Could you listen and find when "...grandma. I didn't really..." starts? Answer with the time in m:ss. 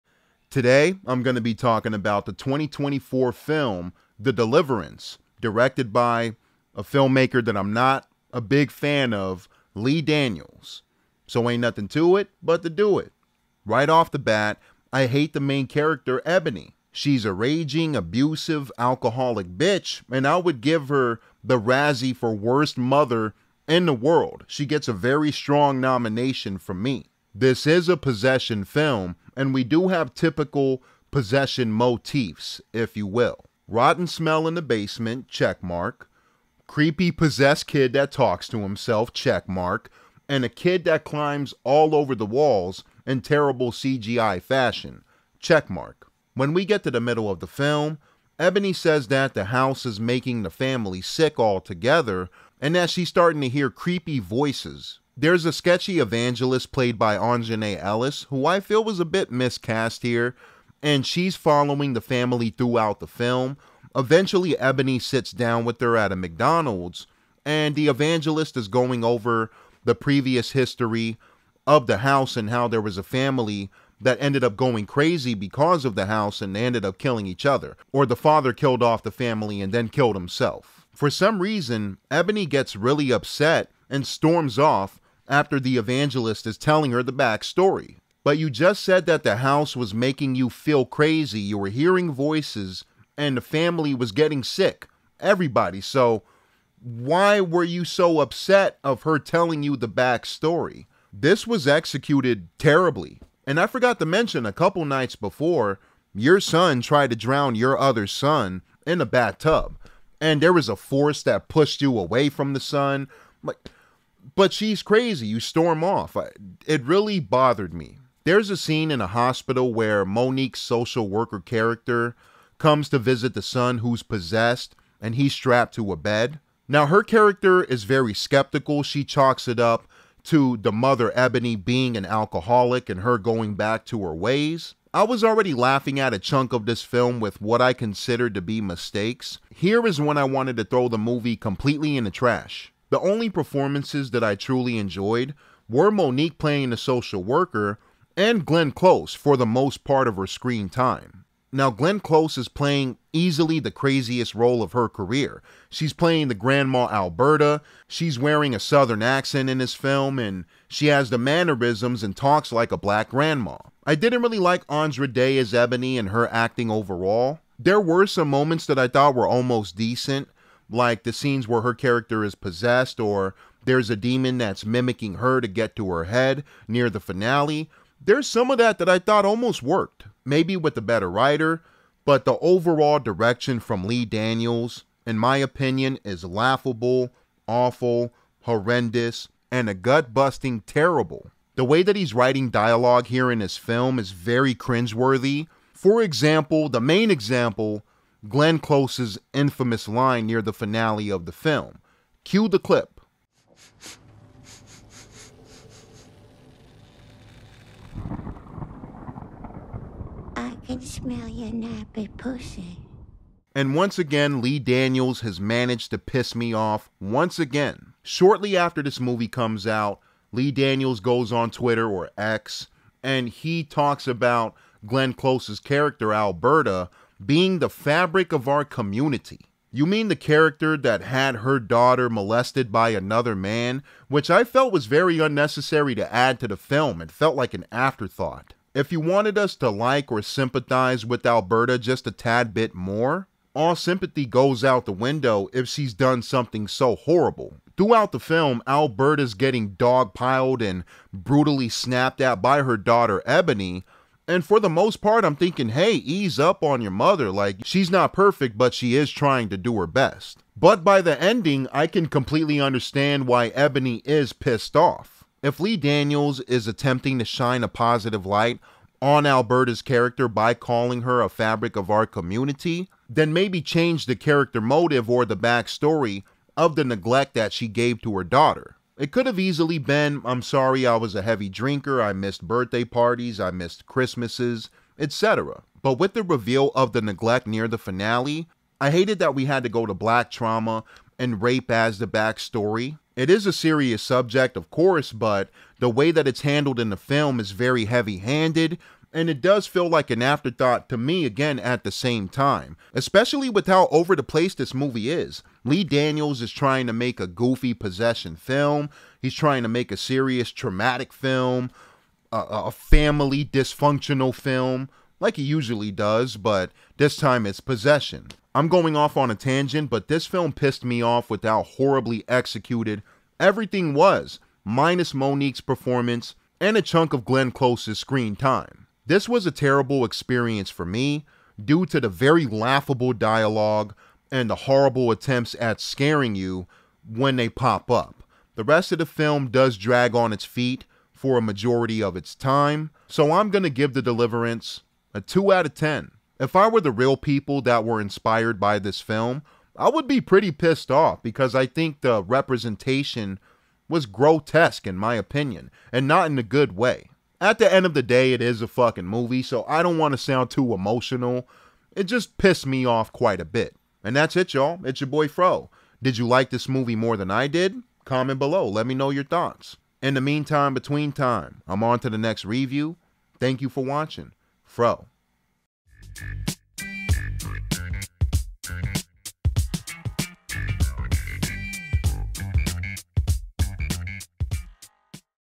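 2:43.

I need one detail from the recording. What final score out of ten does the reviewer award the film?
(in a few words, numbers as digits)
2.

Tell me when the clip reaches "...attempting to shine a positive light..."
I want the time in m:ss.
4:26.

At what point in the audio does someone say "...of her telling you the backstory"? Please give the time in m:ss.
1:38.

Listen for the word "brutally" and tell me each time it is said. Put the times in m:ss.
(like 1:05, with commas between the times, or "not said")
4:11.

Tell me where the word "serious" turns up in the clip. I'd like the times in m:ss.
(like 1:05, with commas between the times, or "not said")
4:53, 5:09.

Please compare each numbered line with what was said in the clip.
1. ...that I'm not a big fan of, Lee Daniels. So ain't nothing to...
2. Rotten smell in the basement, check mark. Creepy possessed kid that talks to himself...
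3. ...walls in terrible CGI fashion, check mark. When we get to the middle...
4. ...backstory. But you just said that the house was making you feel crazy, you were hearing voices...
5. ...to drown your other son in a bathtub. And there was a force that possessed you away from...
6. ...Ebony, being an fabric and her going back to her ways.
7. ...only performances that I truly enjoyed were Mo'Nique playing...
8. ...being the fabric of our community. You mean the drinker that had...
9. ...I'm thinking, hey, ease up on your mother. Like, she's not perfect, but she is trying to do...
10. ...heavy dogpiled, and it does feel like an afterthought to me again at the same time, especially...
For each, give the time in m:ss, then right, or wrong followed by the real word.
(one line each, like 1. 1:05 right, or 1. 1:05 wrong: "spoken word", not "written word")
1. 0:07 right
2. 0:33 right
3. 0:42 right
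4. 1:27 right
5. 1:47 wrong: "pushed", not "possessed"
6. 2:11 wrong: "alcoholic", not "fabric"
7. 2:22 right
8. 3:47 wrong: "character", not "drinker"
9. 4:15 right
10. 4:57 wrong: "handed", not "dogpiled".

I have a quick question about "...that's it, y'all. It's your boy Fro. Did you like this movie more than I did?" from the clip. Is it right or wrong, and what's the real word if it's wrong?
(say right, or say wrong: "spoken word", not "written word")
right.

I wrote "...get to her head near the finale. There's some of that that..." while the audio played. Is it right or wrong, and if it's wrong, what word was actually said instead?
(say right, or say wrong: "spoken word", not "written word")
right.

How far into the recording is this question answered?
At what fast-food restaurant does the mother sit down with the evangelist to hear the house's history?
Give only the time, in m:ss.
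1:06.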